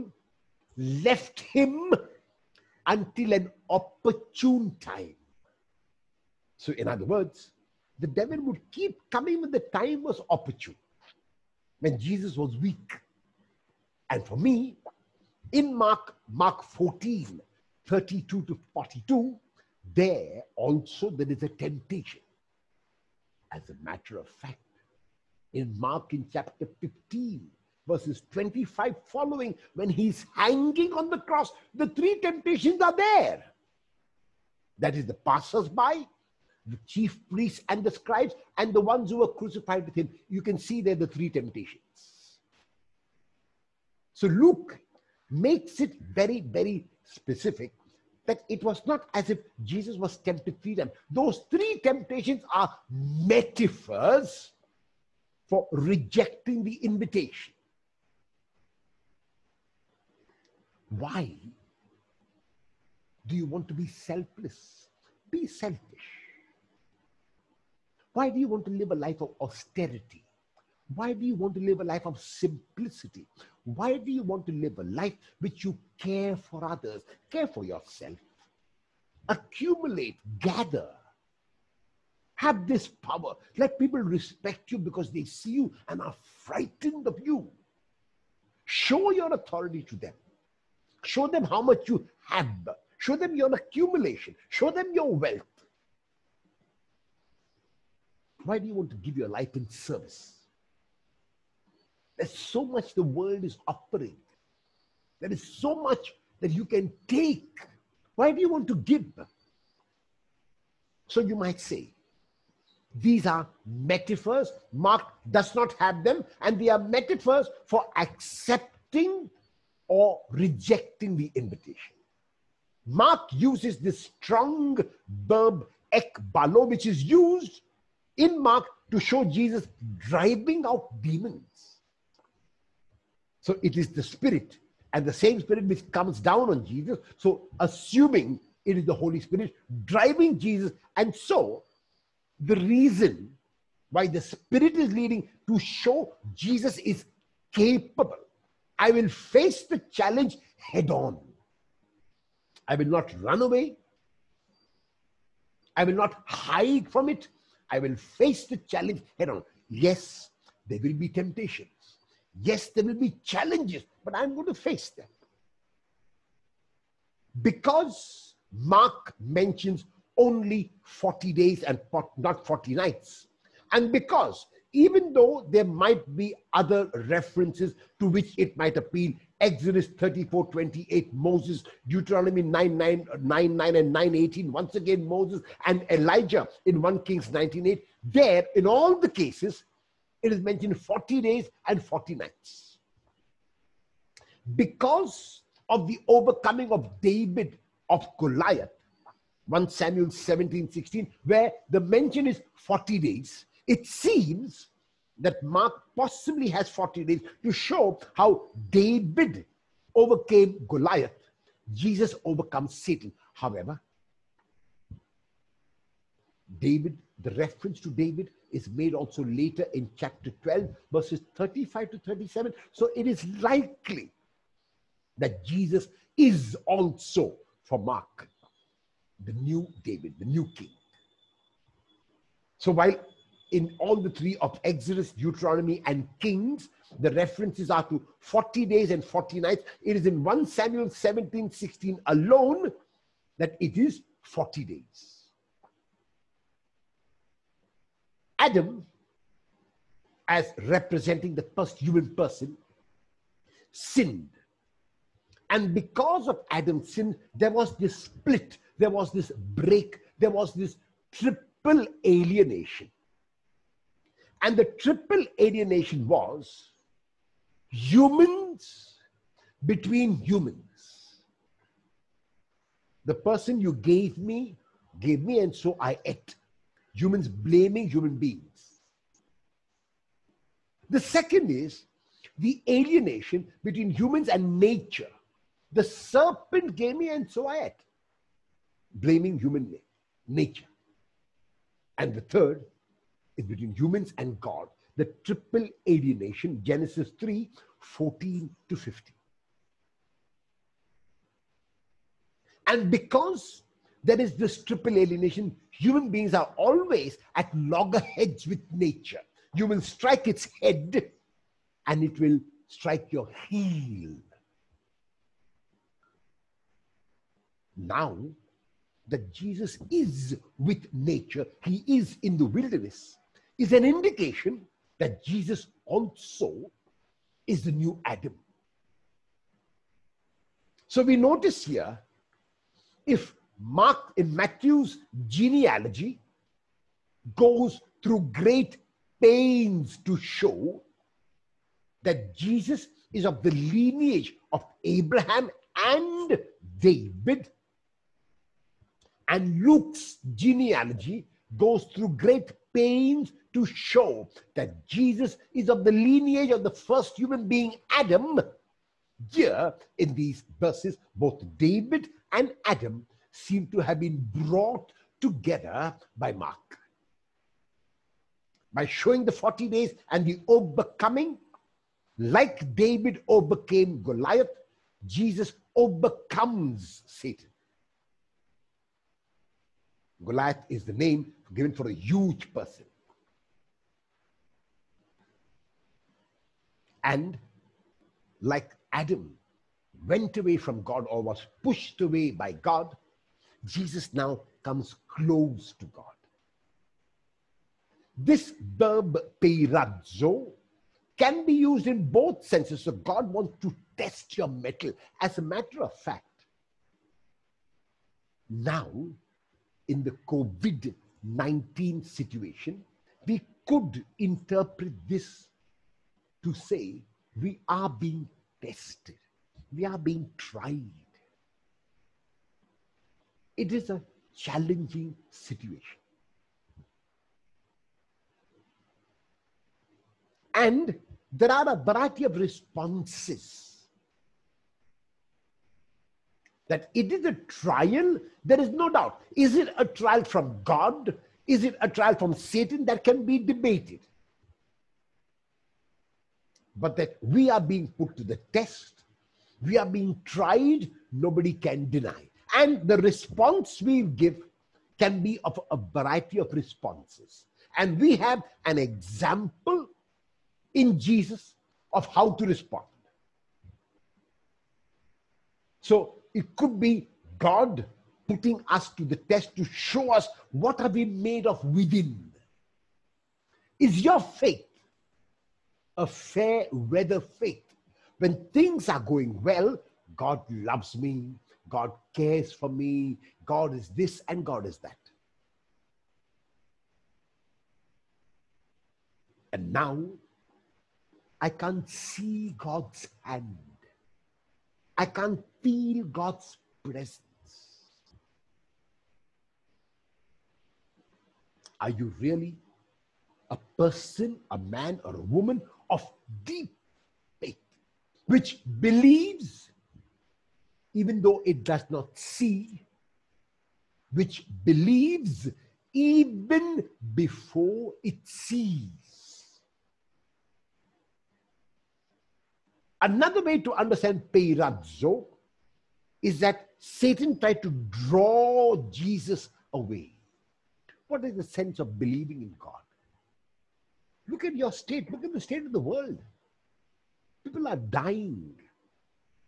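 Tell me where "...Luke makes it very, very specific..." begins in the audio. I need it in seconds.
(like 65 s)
44 s.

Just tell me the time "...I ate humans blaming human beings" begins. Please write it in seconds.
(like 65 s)
275 s.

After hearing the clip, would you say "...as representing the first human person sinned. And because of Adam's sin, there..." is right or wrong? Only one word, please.
right.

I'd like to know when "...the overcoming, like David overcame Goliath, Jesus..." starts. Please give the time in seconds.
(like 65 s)
370 s.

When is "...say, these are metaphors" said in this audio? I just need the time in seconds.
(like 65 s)
111 s.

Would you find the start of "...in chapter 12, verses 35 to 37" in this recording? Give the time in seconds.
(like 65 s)
219 s.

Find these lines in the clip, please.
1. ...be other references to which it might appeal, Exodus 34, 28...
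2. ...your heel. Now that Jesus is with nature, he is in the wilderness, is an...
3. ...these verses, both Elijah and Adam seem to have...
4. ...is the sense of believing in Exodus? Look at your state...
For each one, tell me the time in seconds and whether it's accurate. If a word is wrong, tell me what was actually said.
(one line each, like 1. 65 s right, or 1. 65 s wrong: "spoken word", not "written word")
1. 176 s right
2. 313 s right
3. 360 s wrong: "David", not "Elijah"
4. 531 s wrong: "God", not "Exodus".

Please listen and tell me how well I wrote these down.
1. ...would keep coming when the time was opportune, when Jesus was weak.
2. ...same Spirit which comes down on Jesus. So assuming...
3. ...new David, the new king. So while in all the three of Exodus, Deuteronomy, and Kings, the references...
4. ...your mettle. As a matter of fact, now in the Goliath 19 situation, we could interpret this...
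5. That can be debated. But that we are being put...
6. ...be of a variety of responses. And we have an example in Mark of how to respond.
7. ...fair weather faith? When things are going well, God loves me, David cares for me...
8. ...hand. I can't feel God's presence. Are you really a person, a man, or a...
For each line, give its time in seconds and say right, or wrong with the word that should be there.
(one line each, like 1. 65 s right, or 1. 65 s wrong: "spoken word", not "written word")
1. 8 s right
2. 135 s right
3. 229 s right
4. 404 s wrong: "COVID", not "Goliath"
5. 442 s right
6. 455 s wrong: "Jesus", not "Mark"
7. 476 s wrong: "God", not "David"
8. 493 s right.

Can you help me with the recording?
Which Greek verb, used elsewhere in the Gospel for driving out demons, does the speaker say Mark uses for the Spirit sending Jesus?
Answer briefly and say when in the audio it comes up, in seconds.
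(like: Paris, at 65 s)
ekbalo, at 125 s.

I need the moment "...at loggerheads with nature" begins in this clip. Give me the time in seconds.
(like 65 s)
307 s.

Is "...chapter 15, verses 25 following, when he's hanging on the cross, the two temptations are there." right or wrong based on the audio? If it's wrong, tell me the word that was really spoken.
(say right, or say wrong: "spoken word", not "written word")
wrong: "three", not "two".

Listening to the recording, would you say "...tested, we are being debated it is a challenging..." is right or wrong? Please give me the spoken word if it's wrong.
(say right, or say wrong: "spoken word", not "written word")
wrong: "tried", not "debated".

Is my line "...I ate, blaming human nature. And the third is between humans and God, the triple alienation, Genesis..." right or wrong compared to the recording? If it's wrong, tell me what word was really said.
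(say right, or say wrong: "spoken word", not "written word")
right.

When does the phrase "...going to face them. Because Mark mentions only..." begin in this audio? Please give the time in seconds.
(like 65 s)
164 s.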